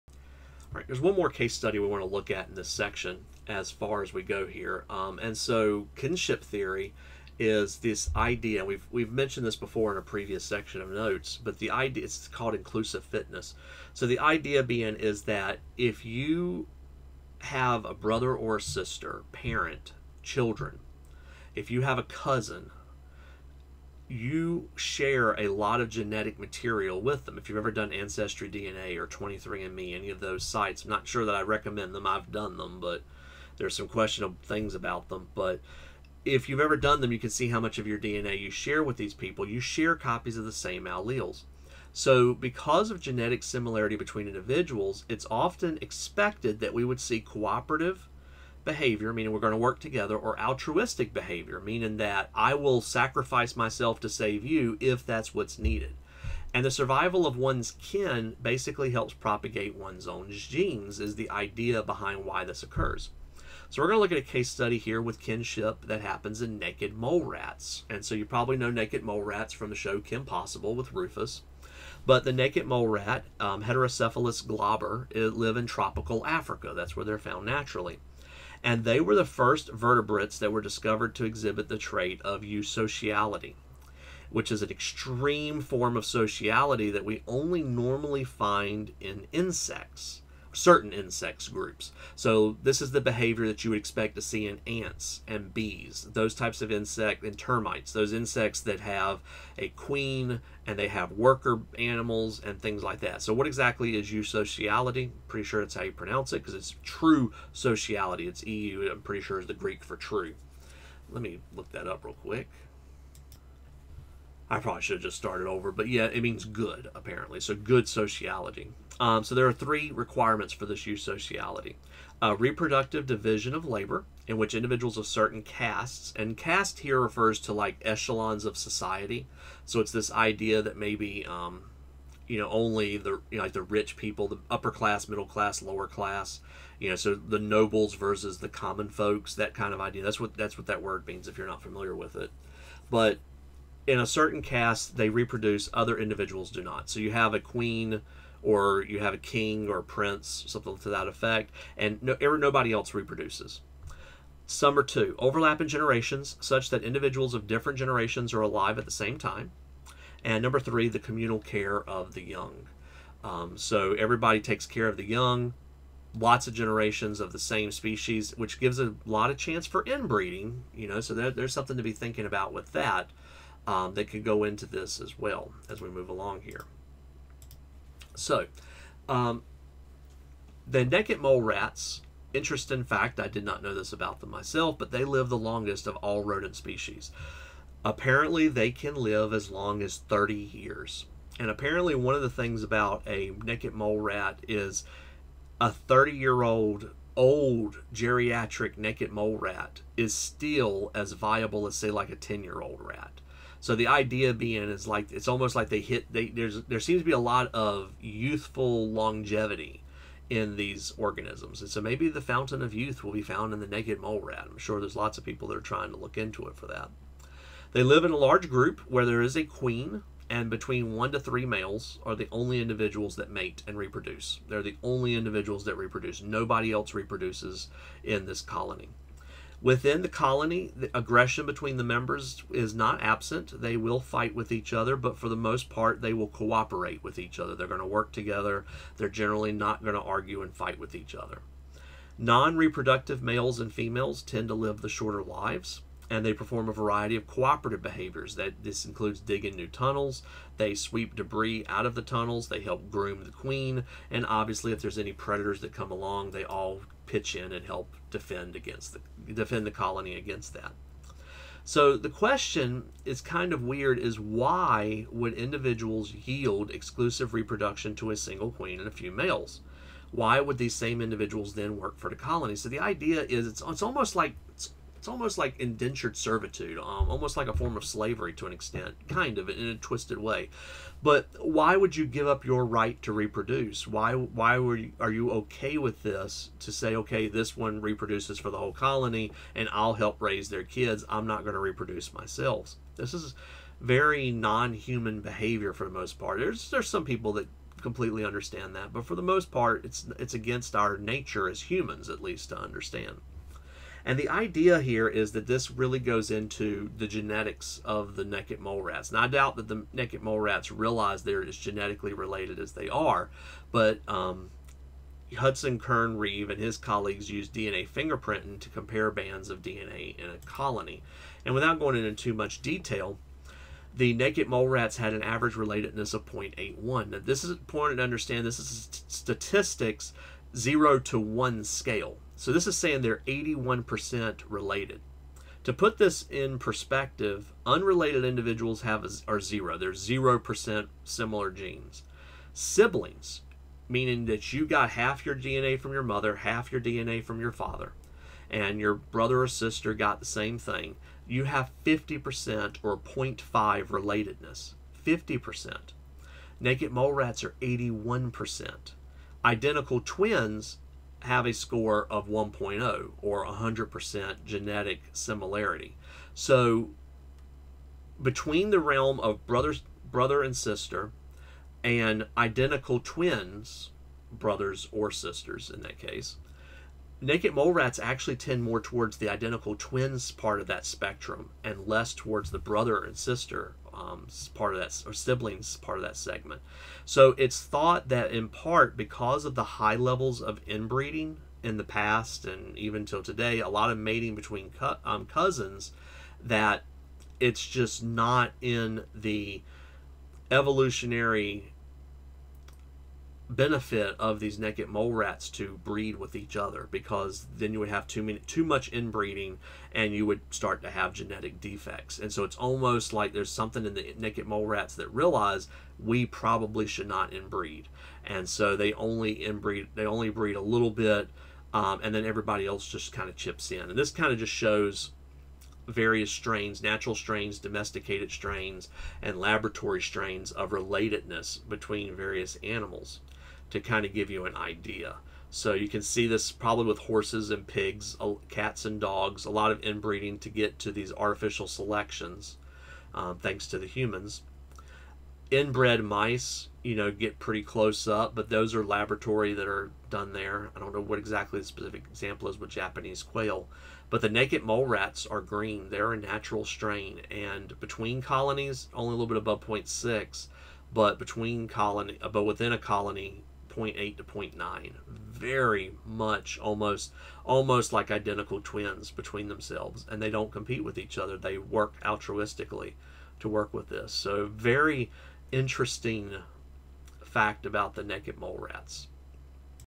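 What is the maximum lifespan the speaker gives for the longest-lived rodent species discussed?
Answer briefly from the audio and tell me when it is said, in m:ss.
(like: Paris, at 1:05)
30 years, at 3:09.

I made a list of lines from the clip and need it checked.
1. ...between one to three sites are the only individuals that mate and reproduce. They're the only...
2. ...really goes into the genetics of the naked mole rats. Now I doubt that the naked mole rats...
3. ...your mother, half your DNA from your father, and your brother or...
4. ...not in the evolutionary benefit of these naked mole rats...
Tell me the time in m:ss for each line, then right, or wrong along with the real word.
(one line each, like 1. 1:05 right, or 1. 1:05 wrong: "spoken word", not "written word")
1. 3:40 wrong: "males", not "sites"
2. 5:05 right
3. 5:45 right
4. 6:38 right.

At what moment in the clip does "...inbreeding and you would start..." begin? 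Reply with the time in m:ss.
6:48.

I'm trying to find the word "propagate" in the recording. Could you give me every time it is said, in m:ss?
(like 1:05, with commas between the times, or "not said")
0:59.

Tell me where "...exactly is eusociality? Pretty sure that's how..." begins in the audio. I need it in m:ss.
1:43.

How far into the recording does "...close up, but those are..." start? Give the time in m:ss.
7:27.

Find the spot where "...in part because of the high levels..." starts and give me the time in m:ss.
6:28.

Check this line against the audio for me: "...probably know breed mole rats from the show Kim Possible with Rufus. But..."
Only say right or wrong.
wrong.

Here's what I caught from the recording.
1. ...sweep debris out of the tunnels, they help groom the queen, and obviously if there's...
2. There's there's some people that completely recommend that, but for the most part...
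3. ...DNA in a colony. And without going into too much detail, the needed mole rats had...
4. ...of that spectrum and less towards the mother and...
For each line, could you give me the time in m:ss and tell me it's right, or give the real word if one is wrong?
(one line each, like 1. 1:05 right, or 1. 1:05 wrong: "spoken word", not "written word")
1. 4:10 right
2. 4:56 wrong: "understand", not "recommend"
3. 5:19 wrong: "naked", not "needed"
4. 6:20 wrong: "brother", not "mother".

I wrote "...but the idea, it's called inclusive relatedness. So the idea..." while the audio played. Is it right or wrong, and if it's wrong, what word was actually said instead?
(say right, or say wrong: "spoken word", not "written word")
wrong: "fitness", not "relatedness".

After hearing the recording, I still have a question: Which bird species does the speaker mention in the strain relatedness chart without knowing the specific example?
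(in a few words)
Japanese quail.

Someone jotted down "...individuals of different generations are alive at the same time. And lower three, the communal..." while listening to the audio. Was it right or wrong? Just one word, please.
wrong.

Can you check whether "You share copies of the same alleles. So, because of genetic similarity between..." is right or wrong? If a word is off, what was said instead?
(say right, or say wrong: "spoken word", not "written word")
right.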